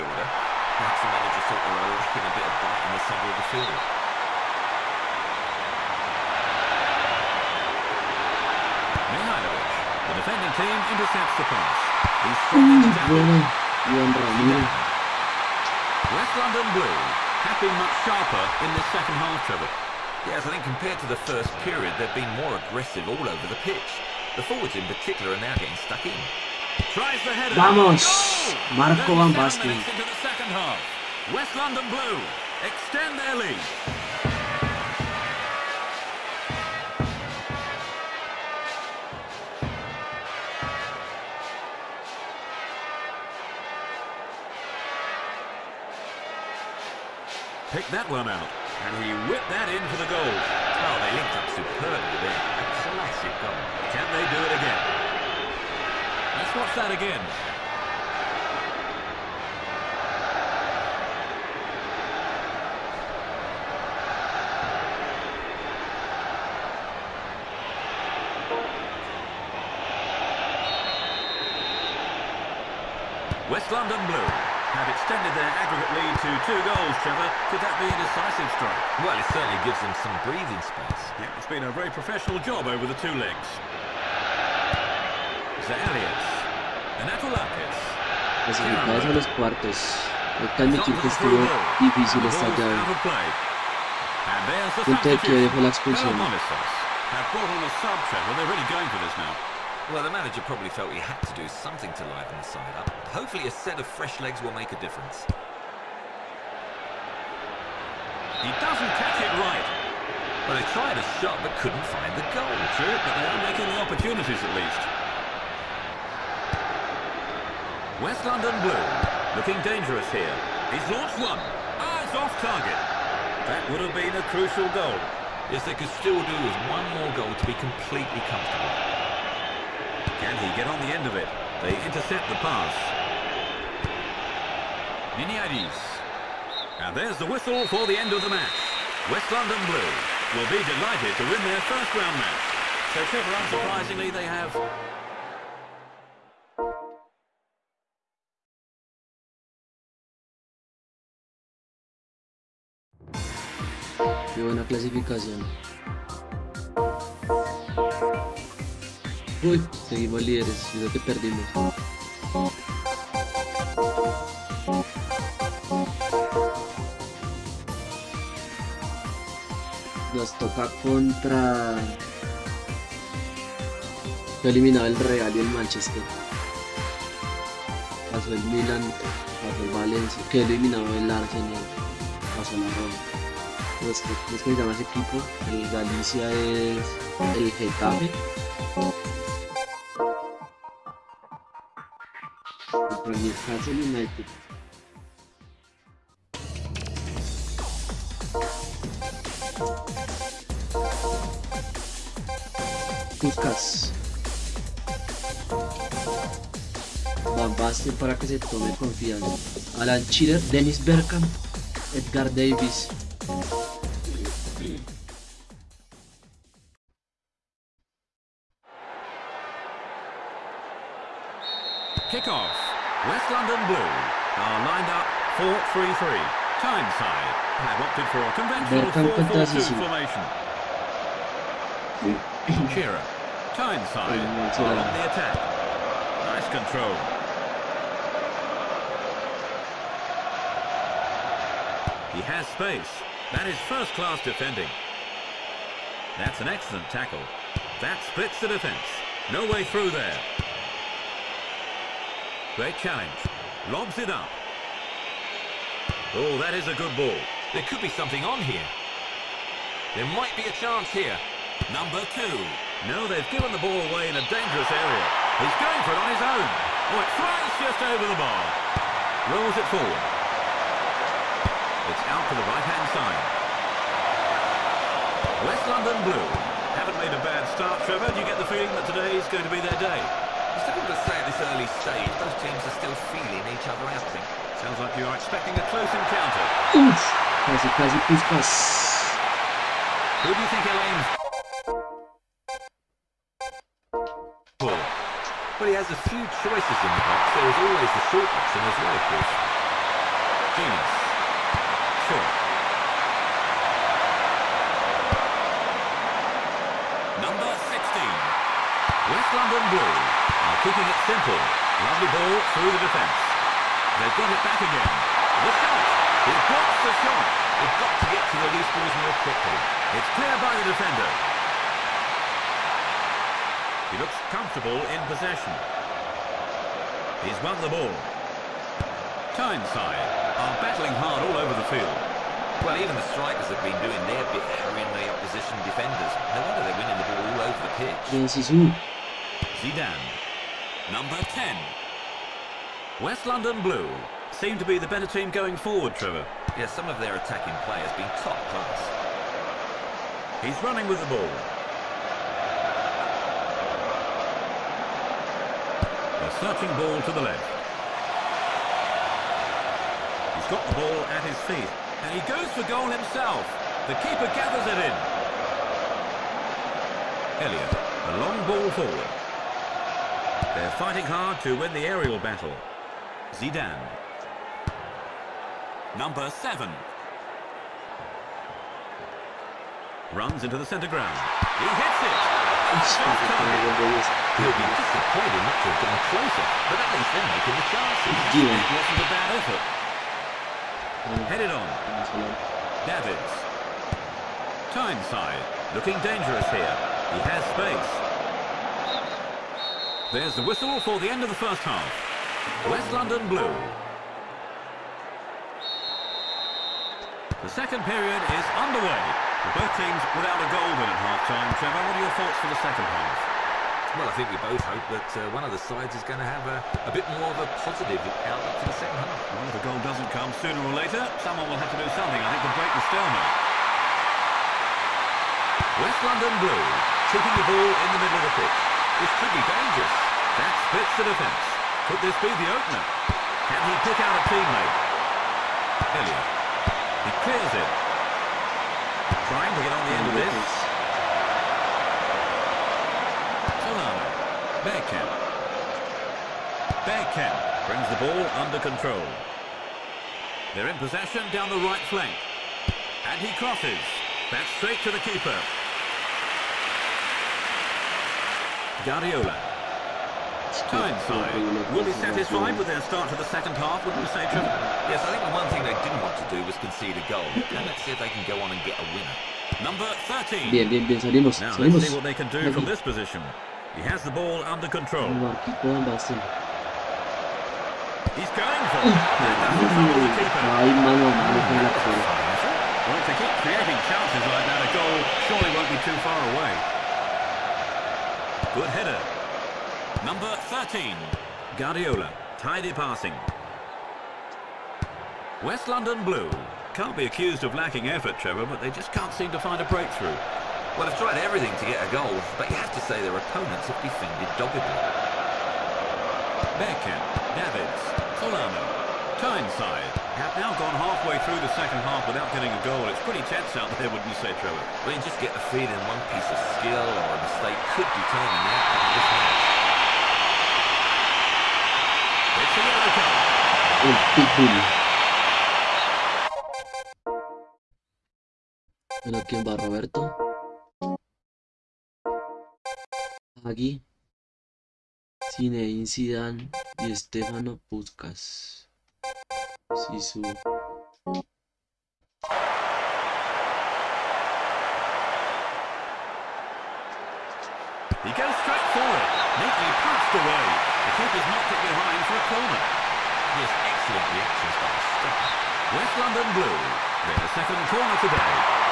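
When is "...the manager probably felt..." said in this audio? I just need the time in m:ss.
1:39.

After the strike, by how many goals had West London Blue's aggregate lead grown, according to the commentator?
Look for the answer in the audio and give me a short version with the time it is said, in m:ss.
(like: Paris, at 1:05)
2, at 1:16.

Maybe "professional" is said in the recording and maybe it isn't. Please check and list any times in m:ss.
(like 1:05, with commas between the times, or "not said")
1:21.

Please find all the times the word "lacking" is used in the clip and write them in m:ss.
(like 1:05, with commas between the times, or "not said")
0:01, 8:17.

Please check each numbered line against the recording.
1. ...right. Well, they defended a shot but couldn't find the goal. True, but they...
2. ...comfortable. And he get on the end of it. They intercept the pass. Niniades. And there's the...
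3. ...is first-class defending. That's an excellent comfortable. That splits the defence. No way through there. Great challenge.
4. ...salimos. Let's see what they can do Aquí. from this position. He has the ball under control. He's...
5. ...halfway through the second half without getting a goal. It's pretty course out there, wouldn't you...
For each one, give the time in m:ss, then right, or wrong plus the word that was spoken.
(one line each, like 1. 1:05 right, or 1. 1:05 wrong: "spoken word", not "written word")
1. 1:49 wrong: "tried", not "defended"
2. 2:08 right
3. 4:03 wrong: "tackle", not "comfortable"
4. 7:51 right
5. 8:30 wrong: "tense", not "course".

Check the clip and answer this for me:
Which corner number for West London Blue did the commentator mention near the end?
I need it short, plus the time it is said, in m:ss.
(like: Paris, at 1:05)
2, at 9:17.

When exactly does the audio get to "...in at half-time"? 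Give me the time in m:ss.
6:50.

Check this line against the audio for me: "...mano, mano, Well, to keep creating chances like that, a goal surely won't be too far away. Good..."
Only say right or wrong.
right.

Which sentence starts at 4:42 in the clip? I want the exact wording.
Both teams are still feeling each other out, I think.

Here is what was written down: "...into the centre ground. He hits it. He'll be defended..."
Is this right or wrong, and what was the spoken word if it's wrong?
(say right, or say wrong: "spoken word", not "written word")
wrong: "disappointed", not "defended".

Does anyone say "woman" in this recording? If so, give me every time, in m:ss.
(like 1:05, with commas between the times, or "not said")
not said.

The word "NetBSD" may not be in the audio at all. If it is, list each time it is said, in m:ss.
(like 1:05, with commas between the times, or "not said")
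not said.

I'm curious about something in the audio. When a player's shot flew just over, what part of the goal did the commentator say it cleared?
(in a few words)
the bar.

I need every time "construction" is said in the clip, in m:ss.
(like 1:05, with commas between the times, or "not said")
not said.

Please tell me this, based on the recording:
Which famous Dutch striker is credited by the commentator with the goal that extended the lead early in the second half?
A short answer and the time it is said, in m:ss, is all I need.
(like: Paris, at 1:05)
Marco Van Basten, at 0:28.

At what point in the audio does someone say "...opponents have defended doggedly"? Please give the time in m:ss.
8:23.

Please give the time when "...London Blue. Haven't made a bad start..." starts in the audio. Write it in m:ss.
4:35.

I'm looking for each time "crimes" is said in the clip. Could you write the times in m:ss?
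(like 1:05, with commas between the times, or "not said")
not said.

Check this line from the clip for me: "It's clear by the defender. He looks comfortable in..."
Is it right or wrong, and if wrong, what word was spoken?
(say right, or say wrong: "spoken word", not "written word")
right.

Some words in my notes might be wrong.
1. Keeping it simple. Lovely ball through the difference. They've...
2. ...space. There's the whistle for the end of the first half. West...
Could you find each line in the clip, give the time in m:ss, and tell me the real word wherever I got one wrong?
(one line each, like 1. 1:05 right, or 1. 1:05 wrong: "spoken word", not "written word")
1. 5:10 wrong: "defence", not "difference"
2. 6:37 right.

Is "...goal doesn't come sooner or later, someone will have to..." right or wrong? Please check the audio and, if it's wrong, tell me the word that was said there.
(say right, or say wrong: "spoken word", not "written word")
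right.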